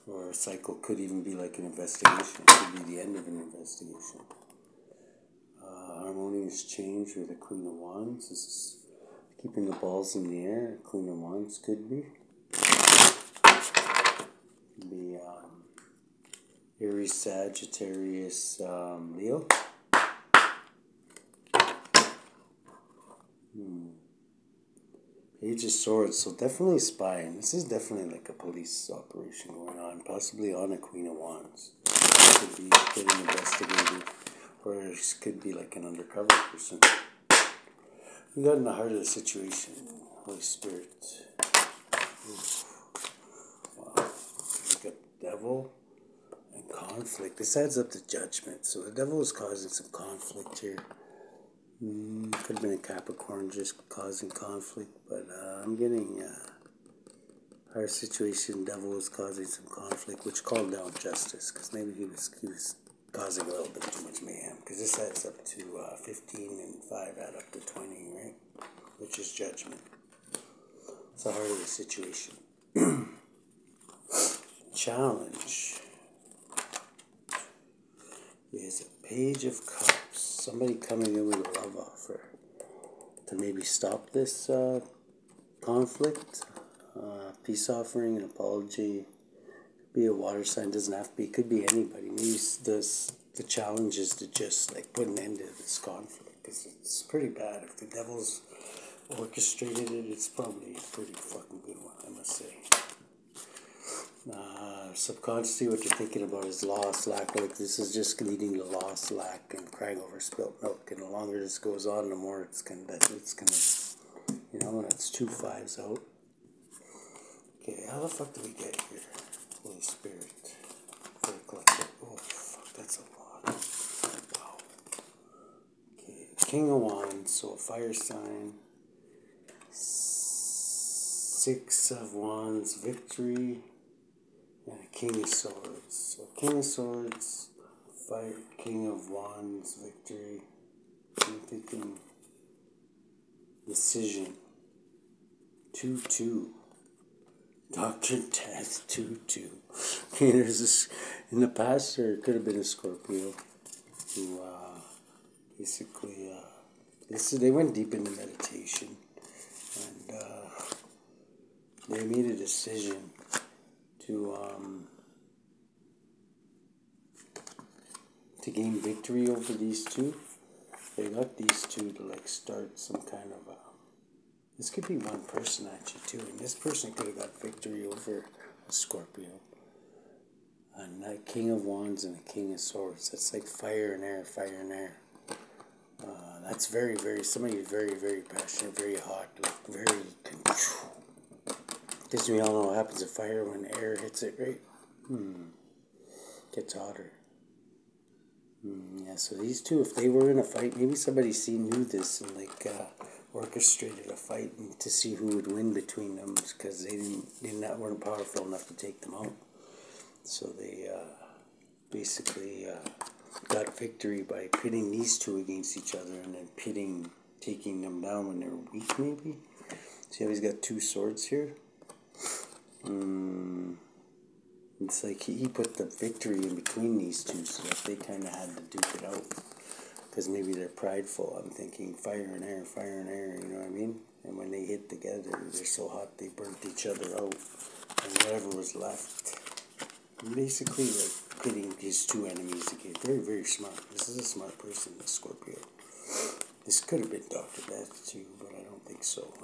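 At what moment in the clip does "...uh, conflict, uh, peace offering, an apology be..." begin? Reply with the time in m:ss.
1:24.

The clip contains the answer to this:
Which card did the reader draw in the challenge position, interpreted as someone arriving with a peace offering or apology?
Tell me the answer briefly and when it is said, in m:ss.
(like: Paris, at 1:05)
Page of Cups, at 1:19.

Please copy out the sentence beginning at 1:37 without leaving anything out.
If the devil's orchestrated it, it's probably a pretty fucking good one.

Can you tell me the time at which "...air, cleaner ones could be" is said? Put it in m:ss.
0:10.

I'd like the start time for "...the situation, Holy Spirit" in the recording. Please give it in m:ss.
0:38.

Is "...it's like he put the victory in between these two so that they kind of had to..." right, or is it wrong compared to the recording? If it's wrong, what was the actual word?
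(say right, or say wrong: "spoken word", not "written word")
right.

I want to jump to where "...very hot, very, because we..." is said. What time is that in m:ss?
3:08.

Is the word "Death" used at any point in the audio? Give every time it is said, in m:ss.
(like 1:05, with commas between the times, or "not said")
2:28, 4:07.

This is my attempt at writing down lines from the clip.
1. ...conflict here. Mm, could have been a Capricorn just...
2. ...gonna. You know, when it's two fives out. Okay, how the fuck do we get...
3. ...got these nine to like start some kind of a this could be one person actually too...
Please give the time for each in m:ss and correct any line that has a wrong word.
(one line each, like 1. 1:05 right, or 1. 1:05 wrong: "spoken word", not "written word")
1. 0:49 right
2. 1:53 right
3. 2:51 wrong: "two", not "nine".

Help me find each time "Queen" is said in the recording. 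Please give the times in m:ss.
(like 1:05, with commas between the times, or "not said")
0:07, 0:30.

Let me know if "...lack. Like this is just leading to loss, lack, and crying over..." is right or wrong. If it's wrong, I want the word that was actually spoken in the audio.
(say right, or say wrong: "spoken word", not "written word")
right.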